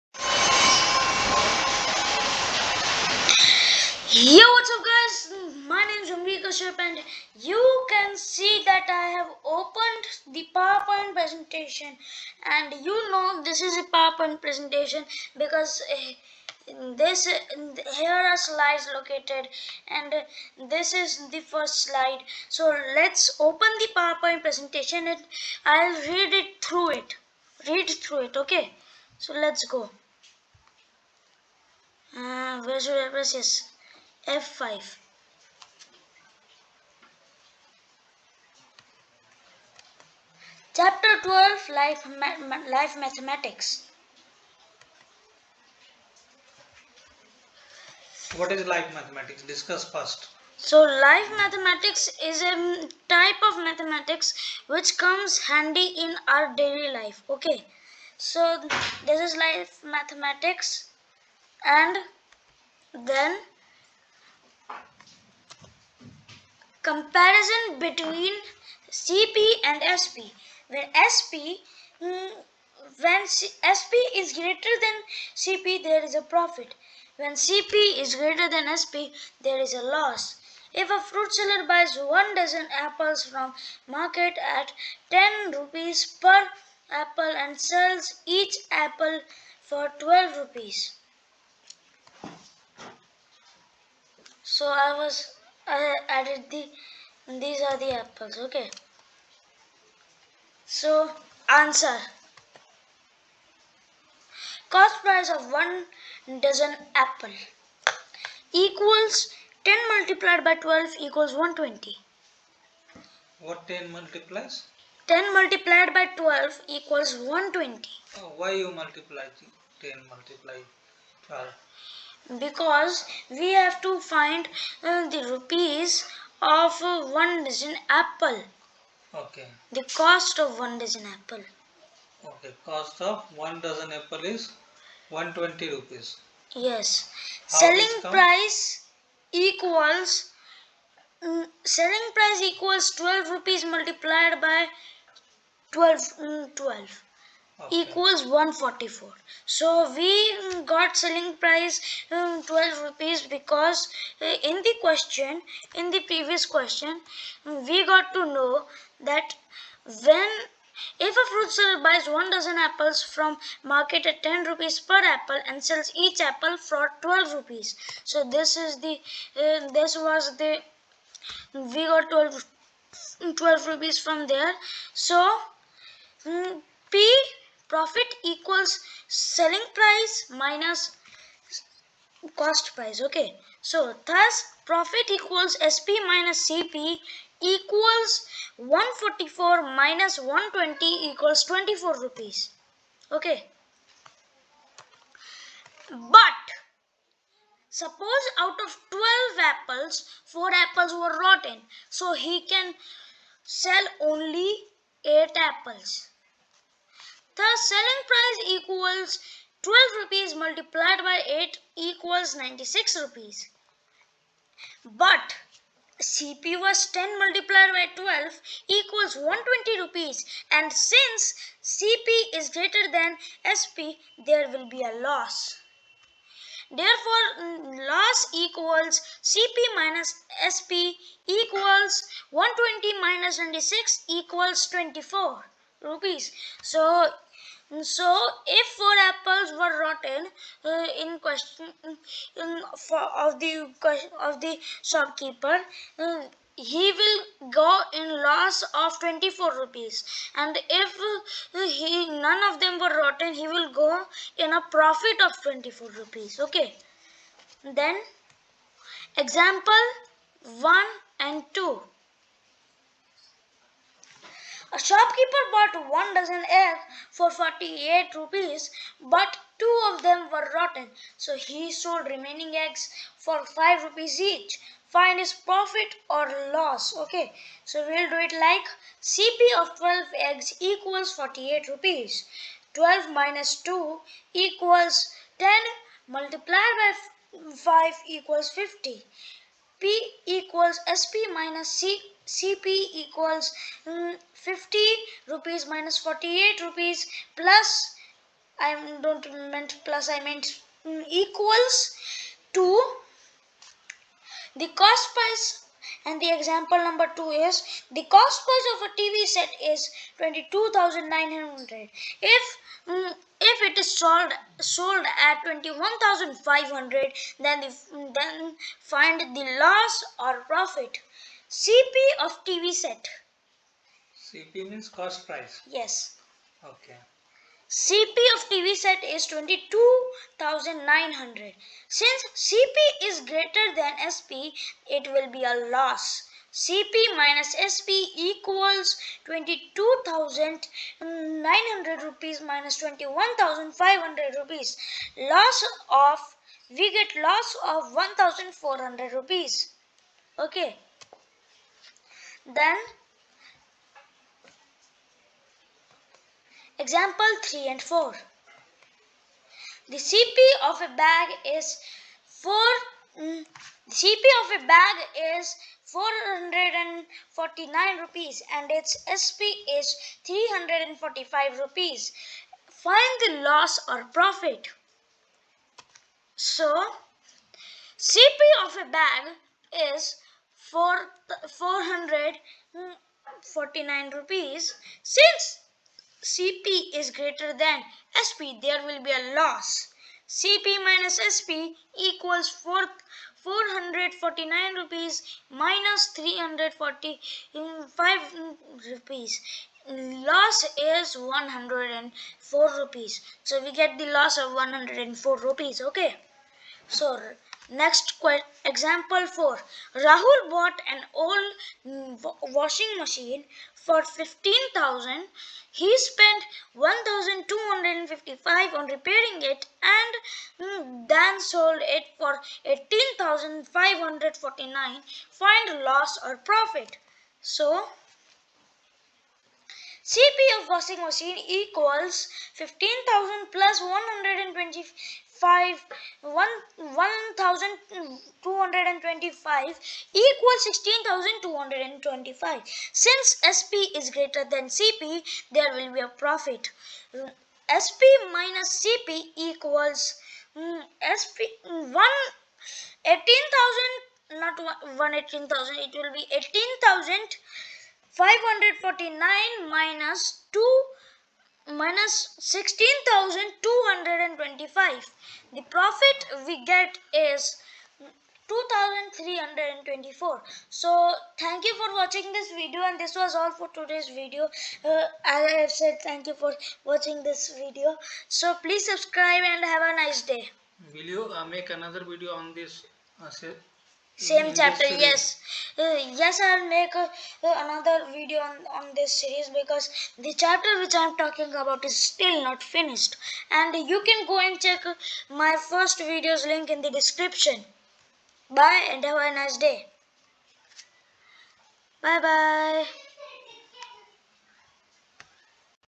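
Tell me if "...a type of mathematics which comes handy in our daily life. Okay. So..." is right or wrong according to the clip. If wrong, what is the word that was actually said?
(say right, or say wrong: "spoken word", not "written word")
right.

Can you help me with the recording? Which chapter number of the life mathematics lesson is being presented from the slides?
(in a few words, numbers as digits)
12.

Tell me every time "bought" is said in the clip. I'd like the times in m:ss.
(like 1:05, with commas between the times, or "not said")
4:25, 6:50.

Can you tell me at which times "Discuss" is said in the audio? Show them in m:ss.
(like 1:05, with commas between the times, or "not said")
0:49.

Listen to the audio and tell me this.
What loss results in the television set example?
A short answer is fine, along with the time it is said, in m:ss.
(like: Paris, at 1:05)
1,400 rupees, at 5:47.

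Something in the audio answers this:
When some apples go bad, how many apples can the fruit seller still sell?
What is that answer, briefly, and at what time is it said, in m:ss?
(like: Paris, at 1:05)
8, at 3:22.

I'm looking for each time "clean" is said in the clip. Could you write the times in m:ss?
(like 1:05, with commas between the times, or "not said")
not said.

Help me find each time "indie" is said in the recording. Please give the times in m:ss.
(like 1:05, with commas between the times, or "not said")
not said.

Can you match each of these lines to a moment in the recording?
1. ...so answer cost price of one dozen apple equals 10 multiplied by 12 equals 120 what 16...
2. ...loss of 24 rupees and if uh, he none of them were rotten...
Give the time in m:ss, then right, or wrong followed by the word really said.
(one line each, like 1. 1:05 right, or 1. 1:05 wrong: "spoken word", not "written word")
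1. 1:40 wrong: "10", not "16"
2. 4:08 right.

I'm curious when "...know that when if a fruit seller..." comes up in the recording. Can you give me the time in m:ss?
2:38.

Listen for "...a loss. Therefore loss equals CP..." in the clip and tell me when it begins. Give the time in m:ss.
3:44.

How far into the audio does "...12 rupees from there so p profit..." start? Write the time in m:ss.
2:53.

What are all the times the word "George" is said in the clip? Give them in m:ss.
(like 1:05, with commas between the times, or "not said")
not said.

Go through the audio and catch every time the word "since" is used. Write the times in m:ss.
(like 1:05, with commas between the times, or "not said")
3:40, 5:31, 6:25, 7:22.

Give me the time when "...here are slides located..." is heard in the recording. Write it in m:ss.
0:17.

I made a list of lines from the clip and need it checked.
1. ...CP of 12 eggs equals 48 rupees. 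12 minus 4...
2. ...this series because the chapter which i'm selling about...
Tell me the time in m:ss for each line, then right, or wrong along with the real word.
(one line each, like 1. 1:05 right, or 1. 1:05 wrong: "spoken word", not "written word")
1. 4:39 wrong: "2", not "4"
2. 8:08 wrong: "talking", not "selling".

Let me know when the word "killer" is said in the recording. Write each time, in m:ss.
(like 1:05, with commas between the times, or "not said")
not said.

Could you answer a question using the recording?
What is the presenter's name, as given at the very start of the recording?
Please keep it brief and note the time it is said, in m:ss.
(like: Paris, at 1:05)
Umrika Sharp, at 0:06.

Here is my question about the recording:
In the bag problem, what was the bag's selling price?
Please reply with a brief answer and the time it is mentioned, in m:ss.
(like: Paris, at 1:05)
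345 rupees, at 6:10.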